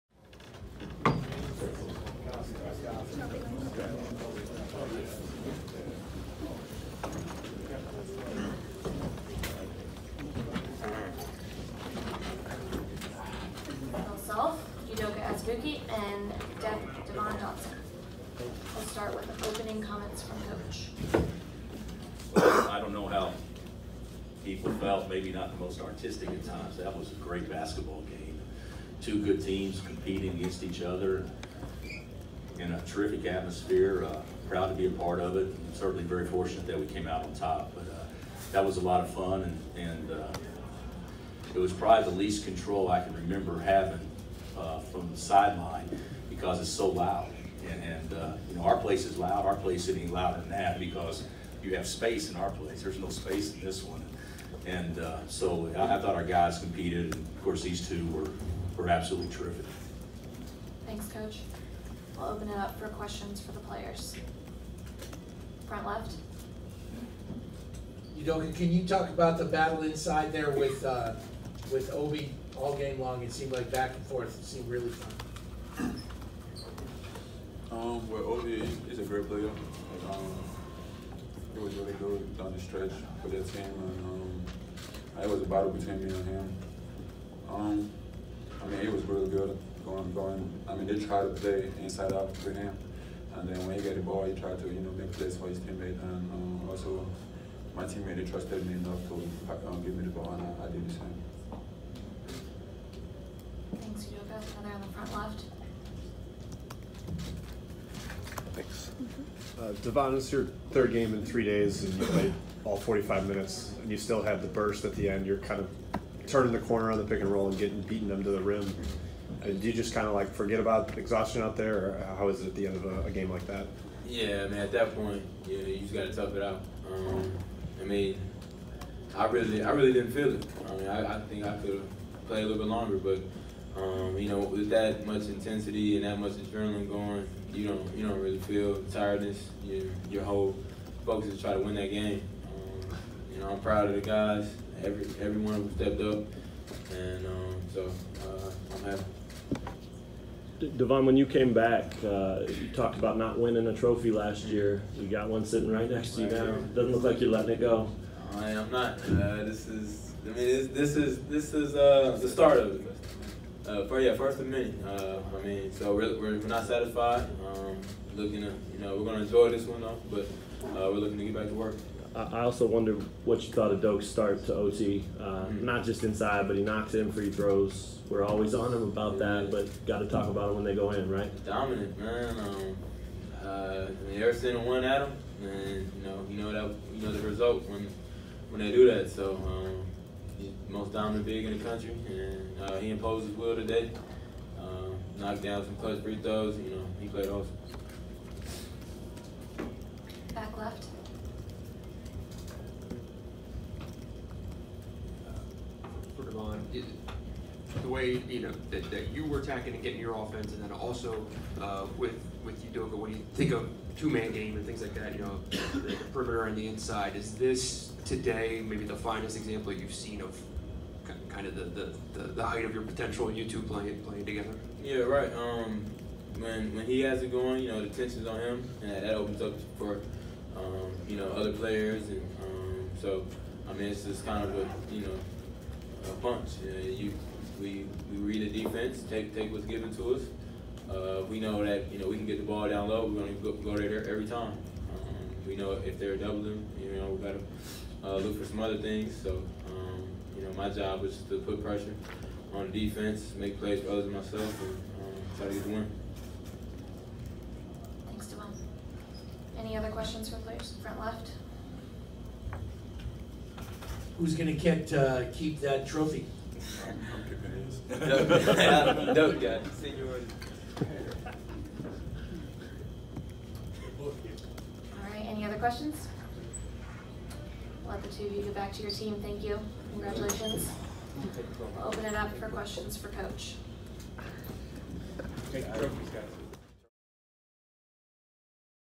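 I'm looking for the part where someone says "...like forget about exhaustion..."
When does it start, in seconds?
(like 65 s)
120 s.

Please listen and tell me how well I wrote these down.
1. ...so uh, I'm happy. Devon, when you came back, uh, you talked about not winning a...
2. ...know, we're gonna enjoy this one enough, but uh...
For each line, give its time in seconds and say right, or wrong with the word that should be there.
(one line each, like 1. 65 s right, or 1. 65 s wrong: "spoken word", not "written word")
1. 147 s right
2. 168 s wrong: "though", not "enough".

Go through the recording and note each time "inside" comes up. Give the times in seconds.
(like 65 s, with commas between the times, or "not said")
69 s, 91 s, 176 s, 216 s.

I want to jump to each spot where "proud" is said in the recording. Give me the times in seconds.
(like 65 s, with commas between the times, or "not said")
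34 s, 143 s.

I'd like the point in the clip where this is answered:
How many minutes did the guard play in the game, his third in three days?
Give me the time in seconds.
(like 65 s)
112 s.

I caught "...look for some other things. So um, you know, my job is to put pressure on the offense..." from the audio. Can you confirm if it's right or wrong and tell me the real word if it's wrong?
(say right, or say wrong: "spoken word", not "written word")
wrong: "defense", not "offense".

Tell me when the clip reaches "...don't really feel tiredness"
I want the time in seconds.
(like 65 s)
138 s.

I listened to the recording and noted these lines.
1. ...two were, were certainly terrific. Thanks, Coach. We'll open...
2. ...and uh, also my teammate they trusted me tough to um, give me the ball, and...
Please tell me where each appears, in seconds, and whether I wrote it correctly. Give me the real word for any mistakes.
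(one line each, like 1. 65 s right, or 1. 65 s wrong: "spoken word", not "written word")
1. 57 s wrong: "absolutely", not "certainly"
2. 96 s wrong: "enough", not "tough".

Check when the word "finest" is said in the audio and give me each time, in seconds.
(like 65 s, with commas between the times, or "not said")
218 s.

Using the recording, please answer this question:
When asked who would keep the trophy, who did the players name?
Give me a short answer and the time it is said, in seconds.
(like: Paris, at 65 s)
Dope guy, at 267 s.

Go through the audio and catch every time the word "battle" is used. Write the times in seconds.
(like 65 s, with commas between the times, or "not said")
69 s, 85 s.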